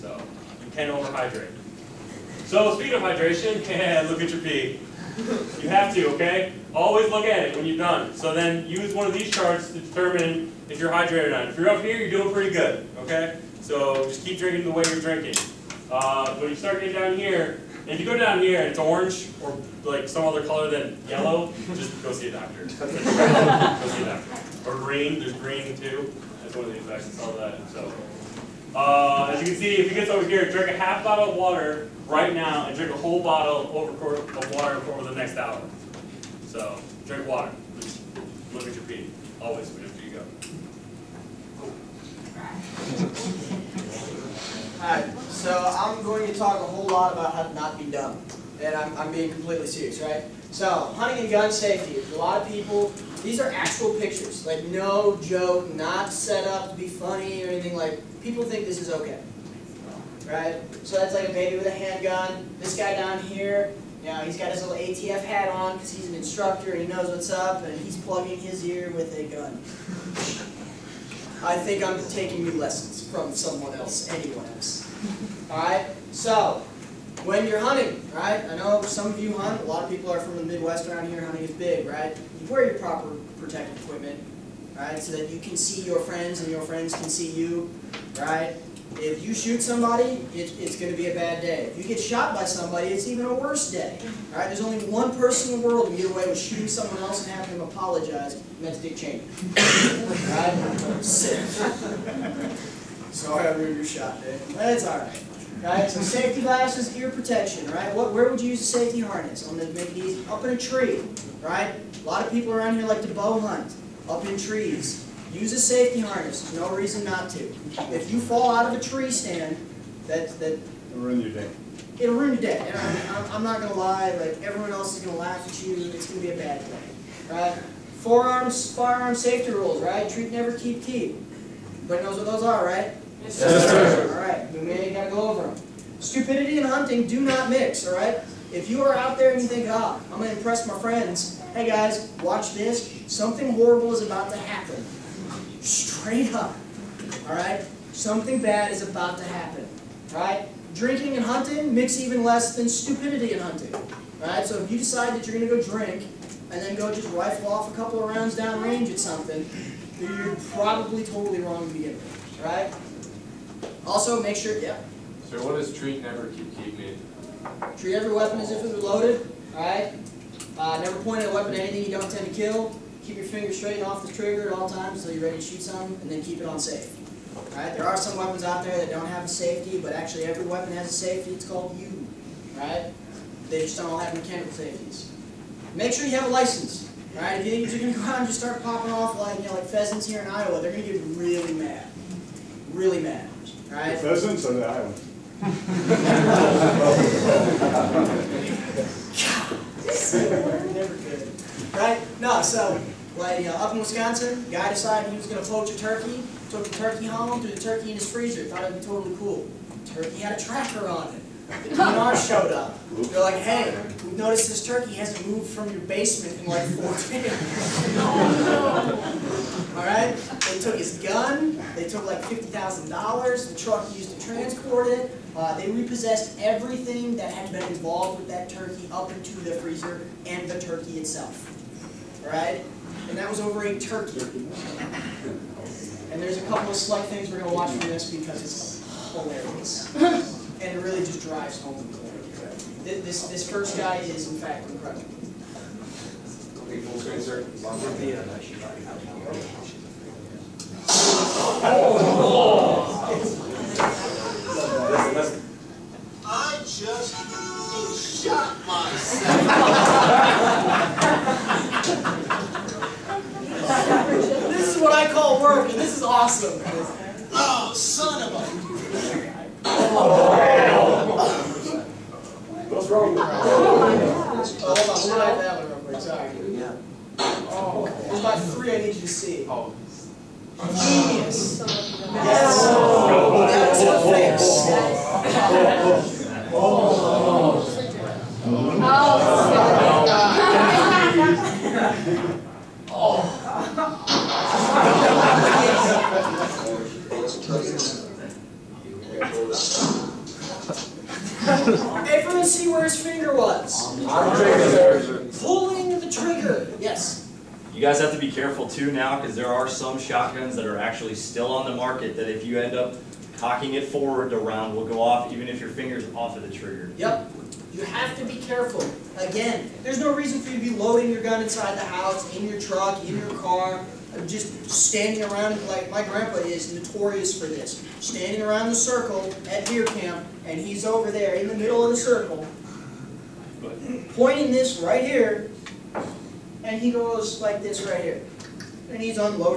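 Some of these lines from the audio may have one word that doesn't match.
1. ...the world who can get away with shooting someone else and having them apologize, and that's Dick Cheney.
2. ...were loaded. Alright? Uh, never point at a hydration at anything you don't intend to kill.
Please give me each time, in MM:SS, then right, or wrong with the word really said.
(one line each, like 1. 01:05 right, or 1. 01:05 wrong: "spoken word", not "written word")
1. 01:35 right
2. 02:48 wrong: "weapon", not "hydration".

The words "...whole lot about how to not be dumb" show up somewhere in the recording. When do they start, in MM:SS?
00:46.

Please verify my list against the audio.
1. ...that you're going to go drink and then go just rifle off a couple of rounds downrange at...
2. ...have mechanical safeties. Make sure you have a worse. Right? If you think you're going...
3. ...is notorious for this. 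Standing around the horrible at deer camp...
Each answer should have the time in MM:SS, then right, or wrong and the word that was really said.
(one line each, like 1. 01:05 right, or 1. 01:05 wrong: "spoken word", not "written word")
1. 02:35 right
2. 03:03 wrong: "license", not "worse"
3. 05:26 wrong: "circle", not "horrible".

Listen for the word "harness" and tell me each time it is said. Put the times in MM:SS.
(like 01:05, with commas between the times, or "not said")
01:48, 01:55.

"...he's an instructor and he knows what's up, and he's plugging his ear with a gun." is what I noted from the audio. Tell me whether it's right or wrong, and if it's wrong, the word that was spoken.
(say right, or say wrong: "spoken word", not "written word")
right.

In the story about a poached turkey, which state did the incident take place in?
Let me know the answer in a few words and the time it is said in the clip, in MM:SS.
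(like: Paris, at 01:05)
Wisconsin, at 03:23.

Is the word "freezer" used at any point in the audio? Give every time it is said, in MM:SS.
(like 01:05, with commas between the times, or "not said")
03:28, 03:49.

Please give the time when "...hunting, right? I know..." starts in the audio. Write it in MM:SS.
01:17.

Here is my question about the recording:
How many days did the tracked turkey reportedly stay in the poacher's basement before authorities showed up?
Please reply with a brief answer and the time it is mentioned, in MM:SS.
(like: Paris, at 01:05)
4, at 03:36.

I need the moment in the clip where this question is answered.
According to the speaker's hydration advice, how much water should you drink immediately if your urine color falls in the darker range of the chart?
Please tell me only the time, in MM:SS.
00:30.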